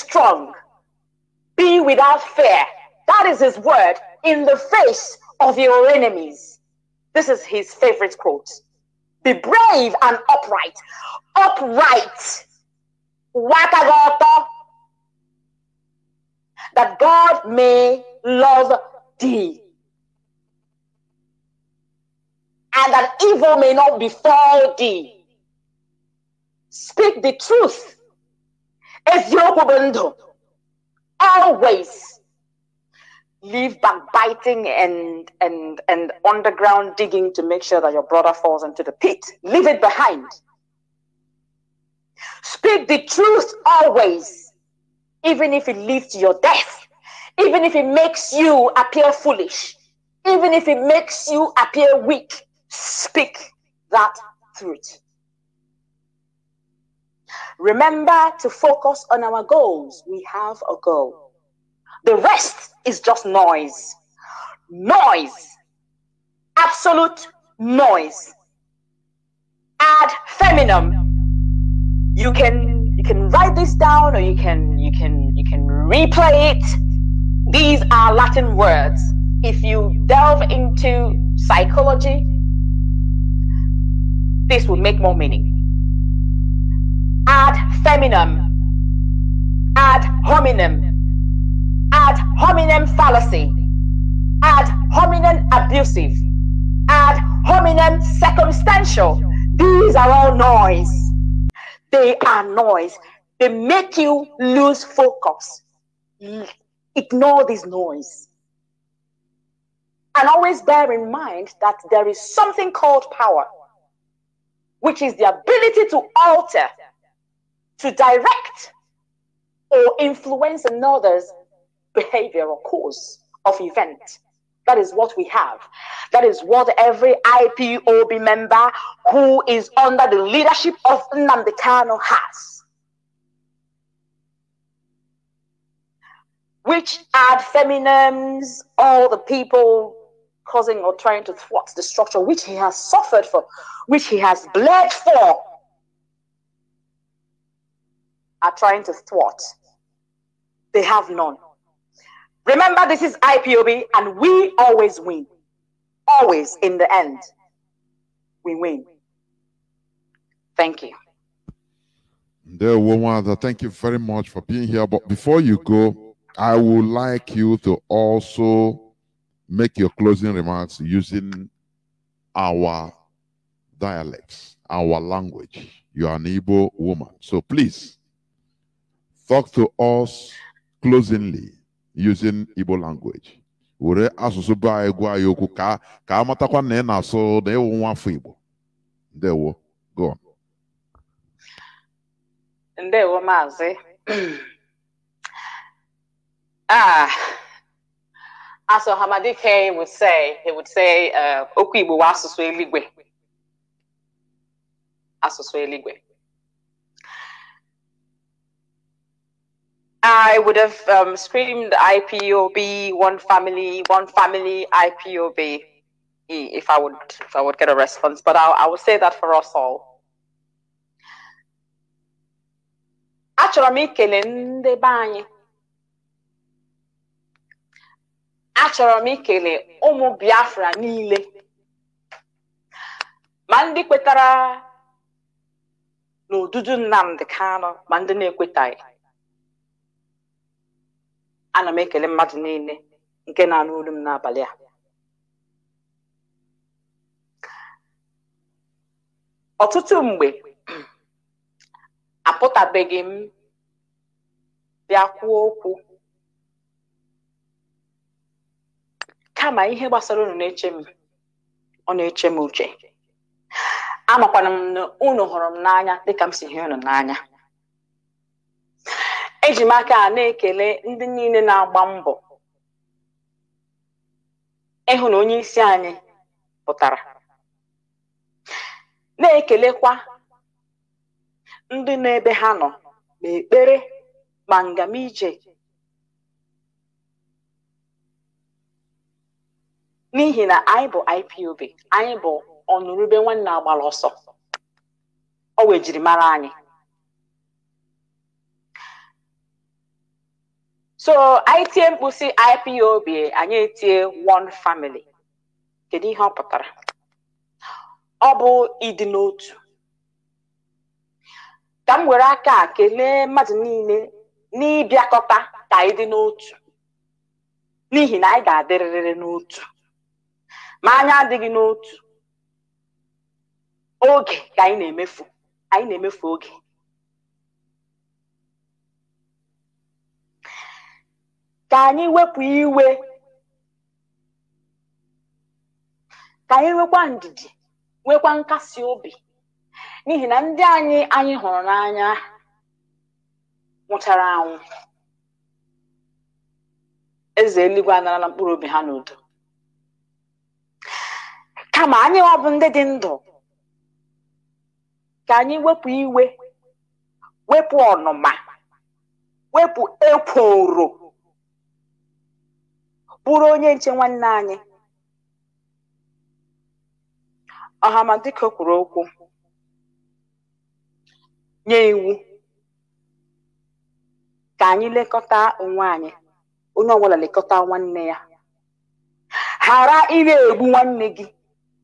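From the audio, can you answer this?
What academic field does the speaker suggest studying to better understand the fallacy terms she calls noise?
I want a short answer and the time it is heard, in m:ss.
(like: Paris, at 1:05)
Psychology, at 1:21.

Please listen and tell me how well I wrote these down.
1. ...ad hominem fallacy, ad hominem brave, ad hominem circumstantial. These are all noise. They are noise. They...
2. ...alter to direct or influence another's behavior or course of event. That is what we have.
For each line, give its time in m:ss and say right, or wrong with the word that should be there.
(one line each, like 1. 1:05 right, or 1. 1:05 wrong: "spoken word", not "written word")
1. 1:32 wrong: "abusive", not "brave"
2. 1:56 right.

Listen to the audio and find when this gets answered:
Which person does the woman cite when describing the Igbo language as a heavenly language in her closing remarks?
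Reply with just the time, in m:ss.
3:18.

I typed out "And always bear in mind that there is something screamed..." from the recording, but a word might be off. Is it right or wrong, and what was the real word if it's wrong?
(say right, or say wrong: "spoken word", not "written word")
wrong: "called", not "screamed".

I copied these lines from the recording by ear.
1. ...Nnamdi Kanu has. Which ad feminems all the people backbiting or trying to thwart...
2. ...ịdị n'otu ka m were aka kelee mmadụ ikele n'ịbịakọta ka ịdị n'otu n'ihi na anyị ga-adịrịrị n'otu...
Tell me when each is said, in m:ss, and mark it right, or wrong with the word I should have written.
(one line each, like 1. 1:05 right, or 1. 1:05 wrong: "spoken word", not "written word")
1. 2:11 wrong: "causing", not "backbiting"
2. 5:08 wrong: "niile", not "ikele".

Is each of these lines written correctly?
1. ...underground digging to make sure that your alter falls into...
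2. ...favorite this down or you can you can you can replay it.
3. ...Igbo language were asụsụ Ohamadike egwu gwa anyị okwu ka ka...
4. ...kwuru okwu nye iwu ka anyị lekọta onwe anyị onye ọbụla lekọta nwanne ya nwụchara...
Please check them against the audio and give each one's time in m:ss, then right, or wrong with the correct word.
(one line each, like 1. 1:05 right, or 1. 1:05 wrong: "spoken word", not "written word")
1. 0:36 wrong: "brother", not "alter"
2. 1:13 wrong: "write", not "favorite"
3. 3:02 wrong: "Baa", not "Ohamadike"
4. 6:08 wrong: "ghara", not "nwụchara".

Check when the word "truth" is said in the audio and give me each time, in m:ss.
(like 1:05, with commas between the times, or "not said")
0:27, 0:43, 0:54.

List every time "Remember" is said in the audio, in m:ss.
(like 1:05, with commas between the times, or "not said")
0:57, 2:32.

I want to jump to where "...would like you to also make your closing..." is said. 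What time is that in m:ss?
2:46.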